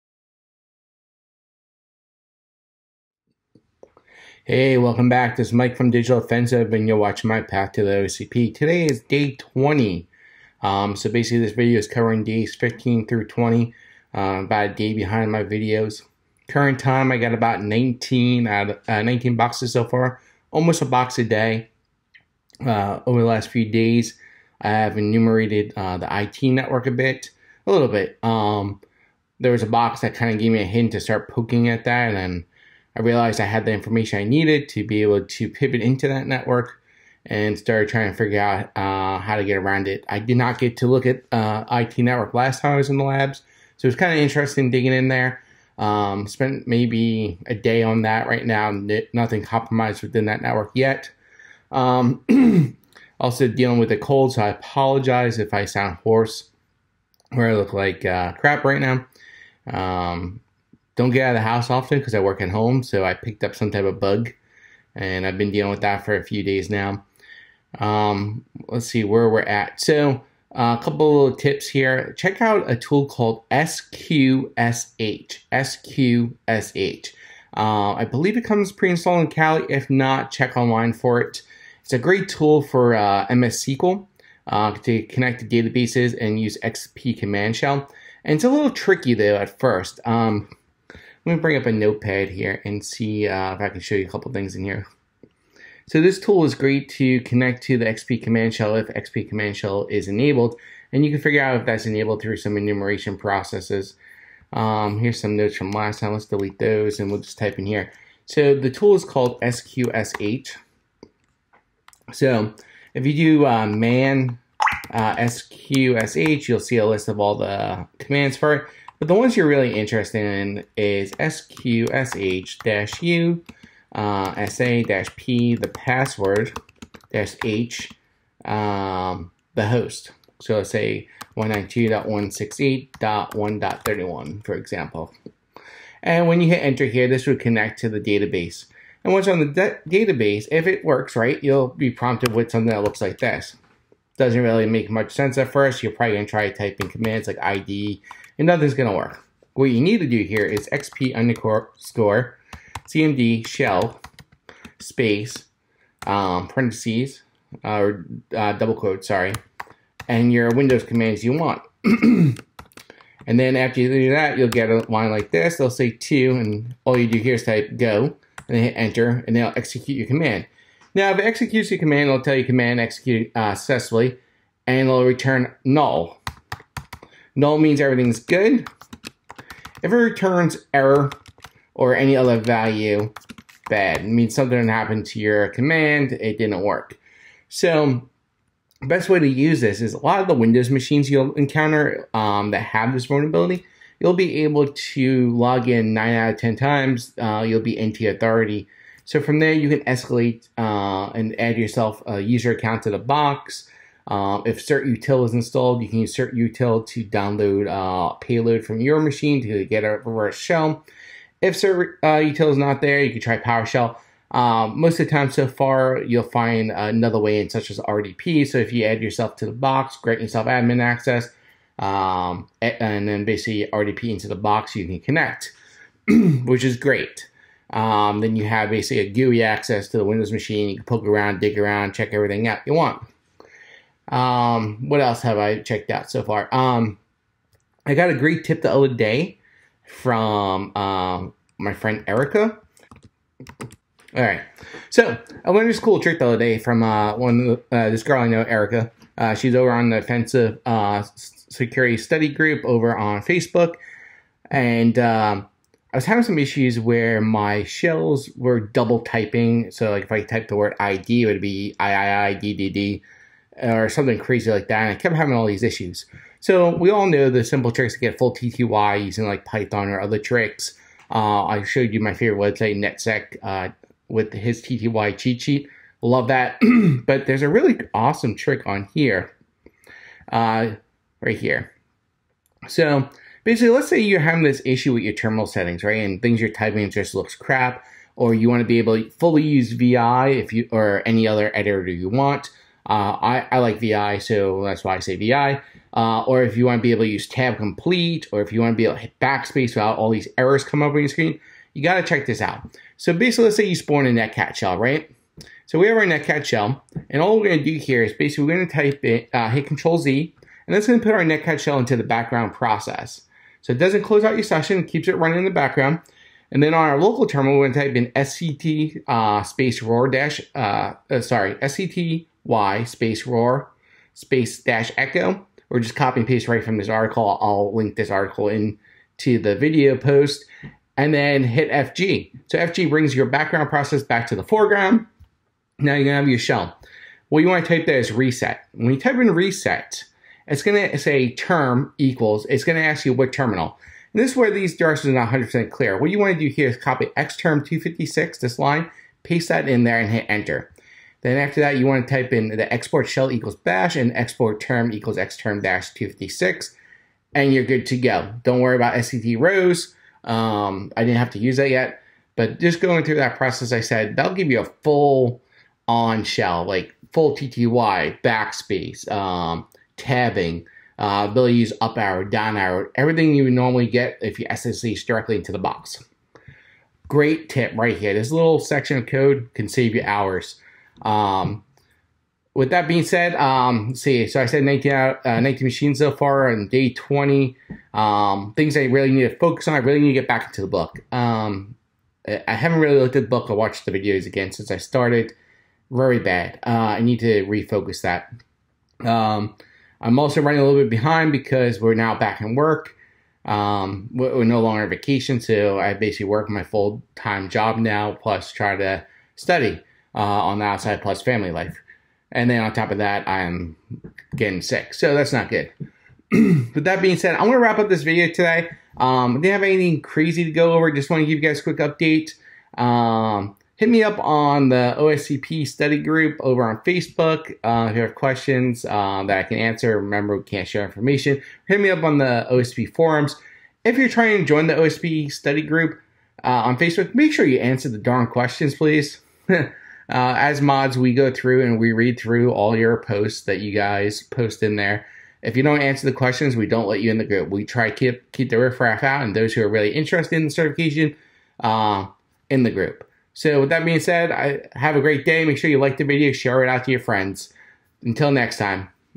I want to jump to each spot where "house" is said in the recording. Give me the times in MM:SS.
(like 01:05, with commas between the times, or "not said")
01:01.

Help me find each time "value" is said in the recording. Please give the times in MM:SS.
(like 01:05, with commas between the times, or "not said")
03:02.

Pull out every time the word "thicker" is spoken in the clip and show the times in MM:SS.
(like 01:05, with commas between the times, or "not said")
not said.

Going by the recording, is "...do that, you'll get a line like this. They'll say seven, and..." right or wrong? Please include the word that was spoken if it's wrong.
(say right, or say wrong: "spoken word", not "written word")
wrong: "two", not "seven".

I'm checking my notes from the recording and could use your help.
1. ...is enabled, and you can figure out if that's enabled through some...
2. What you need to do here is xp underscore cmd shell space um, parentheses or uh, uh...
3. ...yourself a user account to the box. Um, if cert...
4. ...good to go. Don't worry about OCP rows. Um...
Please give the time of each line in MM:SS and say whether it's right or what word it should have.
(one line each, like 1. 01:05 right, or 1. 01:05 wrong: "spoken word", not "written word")
1. 01:39 right
2. 02:29 right
3. 03:21 right
4. 05:57 wrong: "SCD", not "OCP".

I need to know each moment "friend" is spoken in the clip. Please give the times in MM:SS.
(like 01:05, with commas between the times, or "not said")
04:01, 07:36.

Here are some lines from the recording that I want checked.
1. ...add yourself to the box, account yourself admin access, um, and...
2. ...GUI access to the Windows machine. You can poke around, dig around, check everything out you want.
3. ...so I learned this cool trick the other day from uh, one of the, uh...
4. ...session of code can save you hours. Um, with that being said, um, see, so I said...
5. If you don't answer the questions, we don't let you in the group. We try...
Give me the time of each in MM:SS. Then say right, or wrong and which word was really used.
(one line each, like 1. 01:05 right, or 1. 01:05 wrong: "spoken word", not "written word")
1. 03:38 wrong: "grant", not "account"
2. 03:49 right
3. 04:04 right
4. 06:18 wrong: "section", not "session"
5. 07:25 right.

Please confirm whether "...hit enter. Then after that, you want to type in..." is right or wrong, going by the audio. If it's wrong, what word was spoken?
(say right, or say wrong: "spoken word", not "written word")
right.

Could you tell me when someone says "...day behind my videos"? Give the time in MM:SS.
00:14.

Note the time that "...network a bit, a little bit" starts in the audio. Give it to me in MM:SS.
00:26.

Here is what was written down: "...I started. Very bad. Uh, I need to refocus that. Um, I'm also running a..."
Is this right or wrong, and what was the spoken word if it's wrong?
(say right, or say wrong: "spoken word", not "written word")
right.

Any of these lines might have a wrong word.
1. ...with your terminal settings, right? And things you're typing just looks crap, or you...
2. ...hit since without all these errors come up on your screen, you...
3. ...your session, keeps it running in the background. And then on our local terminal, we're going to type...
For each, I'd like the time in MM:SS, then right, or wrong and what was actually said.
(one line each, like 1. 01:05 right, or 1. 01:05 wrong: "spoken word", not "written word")
1. 04:44 right
2. 04:59 wrong: "backspace", not "since"
3. 05:14 right.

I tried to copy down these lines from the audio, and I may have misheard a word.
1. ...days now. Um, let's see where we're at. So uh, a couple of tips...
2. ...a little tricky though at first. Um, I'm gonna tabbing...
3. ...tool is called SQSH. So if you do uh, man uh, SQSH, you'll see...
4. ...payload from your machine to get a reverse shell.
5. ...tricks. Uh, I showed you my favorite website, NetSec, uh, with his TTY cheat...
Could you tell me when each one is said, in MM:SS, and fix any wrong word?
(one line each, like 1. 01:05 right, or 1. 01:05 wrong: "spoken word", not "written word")
1. 01:06 right
2. 01:28 wrong: "bring", not "tabbing"
3. 01:48 right
4. 03:28 right
5. 04:30 right.